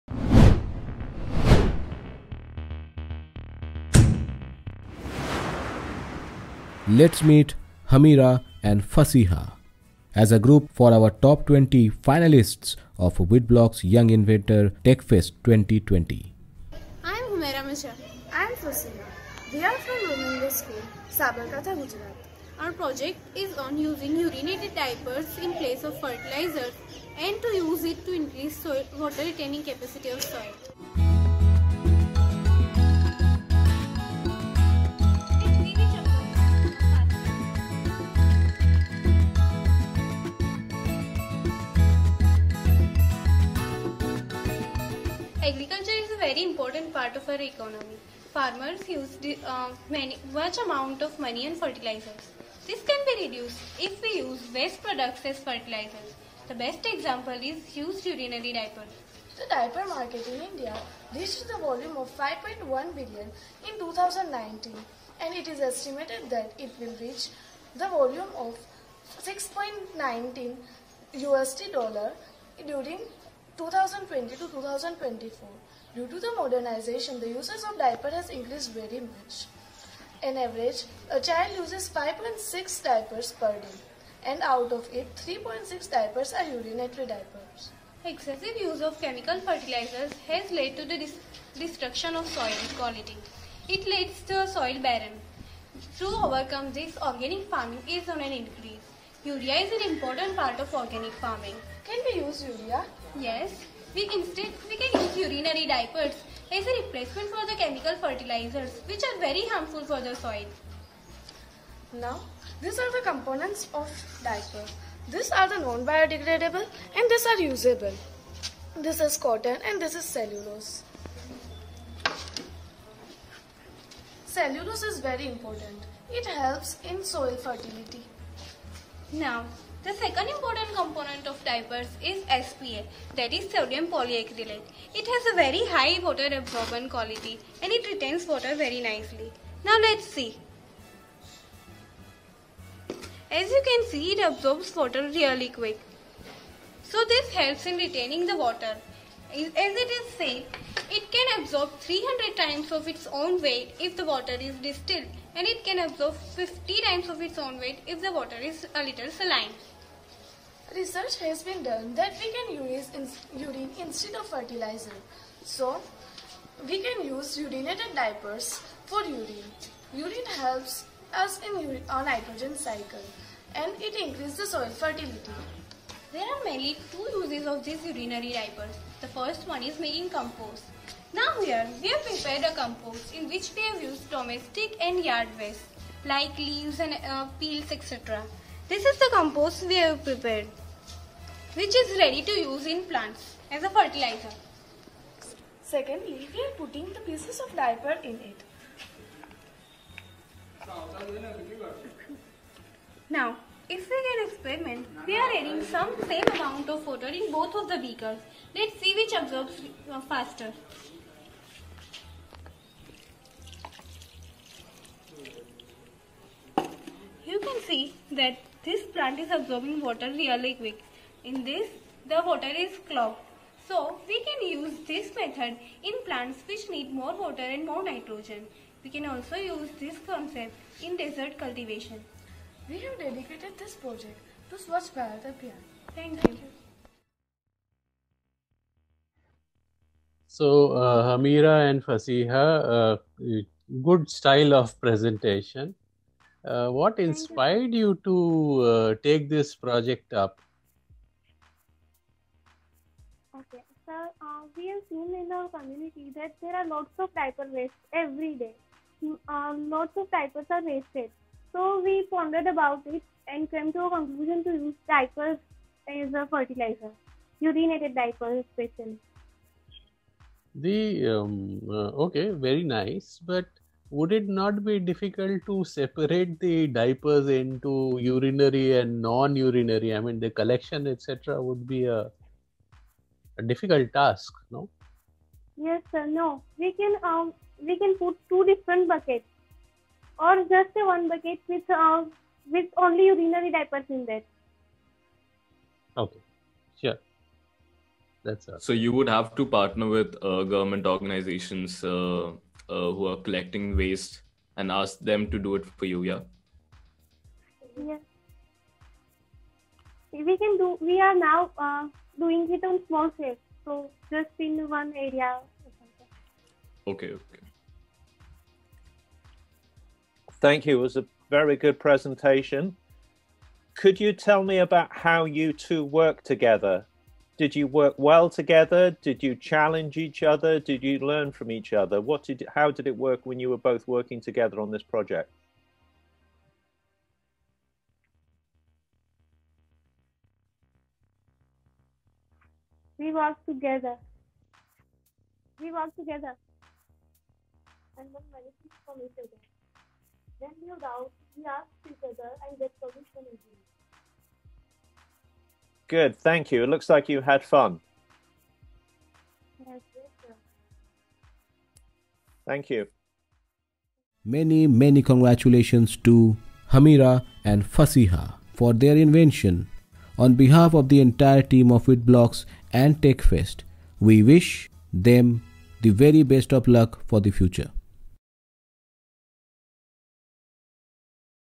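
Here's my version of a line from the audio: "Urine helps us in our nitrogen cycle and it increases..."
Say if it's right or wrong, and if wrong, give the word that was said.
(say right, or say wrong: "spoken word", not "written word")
right.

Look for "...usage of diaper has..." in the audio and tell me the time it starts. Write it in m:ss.
1:17.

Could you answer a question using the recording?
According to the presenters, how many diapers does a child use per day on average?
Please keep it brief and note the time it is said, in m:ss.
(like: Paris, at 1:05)
5.6, at 1:21.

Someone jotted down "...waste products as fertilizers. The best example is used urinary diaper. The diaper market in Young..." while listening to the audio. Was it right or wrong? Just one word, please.
wrong.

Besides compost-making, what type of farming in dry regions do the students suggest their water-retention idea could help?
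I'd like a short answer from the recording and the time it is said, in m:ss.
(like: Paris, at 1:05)
desert cultivation, at 3:50.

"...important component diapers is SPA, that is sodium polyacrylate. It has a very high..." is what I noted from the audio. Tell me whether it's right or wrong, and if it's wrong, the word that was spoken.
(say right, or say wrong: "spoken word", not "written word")
right.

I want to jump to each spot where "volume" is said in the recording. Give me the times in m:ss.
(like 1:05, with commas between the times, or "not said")
1:01, 1:07.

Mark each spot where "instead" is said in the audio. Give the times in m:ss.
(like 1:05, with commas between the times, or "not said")
1:44, 2:43.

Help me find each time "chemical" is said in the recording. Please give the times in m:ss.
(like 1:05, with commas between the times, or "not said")
1:29, 1:47.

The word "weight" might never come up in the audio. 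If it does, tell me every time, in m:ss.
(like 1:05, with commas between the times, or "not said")
2:33, 2:37.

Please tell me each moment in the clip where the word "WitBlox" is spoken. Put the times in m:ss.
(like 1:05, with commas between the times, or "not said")
0:13, 6:11.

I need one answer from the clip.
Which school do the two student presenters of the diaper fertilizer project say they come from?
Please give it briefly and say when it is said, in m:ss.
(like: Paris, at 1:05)
Romingo School, at 0:20.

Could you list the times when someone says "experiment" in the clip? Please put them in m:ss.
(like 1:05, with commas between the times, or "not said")
3:24.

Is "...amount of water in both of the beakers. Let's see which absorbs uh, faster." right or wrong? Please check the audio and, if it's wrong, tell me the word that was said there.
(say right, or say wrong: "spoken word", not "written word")
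right.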